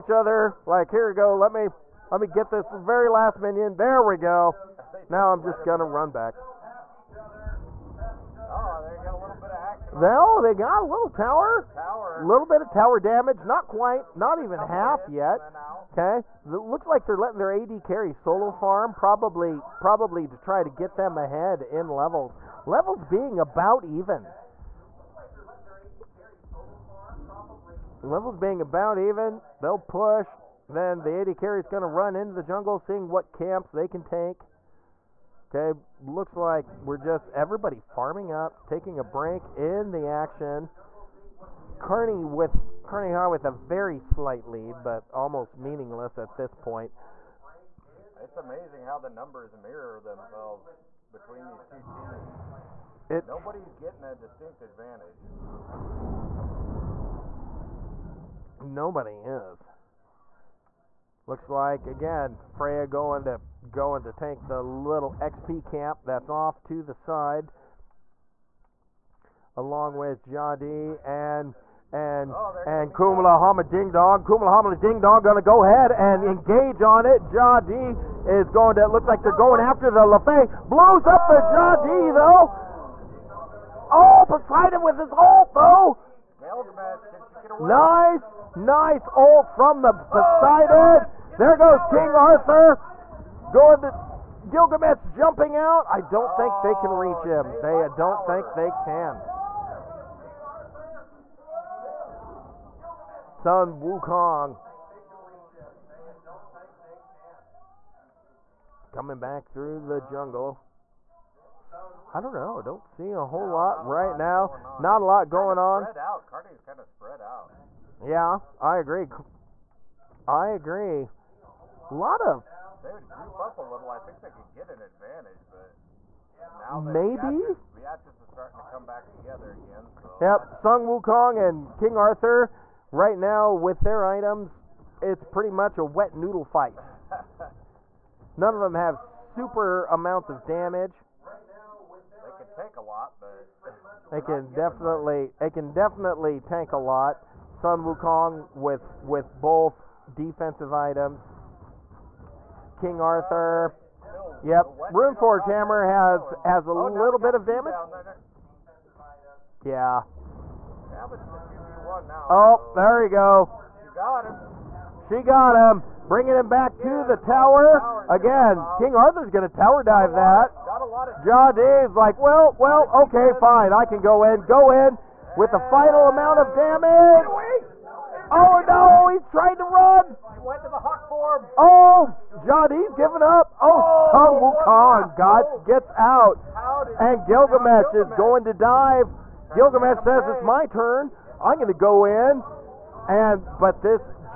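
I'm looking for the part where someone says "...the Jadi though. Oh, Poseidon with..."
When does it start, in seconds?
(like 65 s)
81 s.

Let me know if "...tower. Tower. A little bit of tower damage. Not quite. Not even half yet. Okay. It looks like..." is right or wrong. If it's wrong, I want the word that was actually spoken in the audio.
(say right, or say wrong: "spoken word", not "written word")
right.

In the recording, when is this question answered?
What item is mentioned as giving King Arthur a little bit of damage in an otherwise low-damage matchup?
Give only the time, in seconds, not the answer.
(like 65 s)
154 s.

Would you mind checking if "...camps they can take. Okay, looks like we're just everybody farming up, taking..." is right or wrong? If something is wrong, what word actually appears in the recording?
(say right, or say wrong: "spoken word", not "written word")
right.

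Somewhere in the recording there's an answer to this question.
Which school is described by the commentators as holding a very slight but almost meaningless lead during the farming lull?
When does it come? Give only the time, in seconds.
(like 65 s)
42 s.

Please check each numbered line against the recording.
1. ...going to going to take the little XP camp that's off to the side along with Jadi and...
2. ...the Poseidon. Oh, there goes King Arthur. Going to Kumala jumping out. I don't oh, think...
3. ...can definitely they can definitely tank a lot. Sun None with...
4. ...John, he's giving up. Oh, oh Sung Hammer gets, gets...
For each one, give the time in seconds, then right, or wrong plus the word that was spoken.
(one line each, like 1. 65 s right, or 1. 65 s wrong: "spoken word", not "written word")
1. 62 s right
2. 89 s wrong: "Gilgamesh", not "Kumala"
3. 144 s wrong: "Wukong", not "None"
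4. 182 s wrong: "Wukong", not "Hammer".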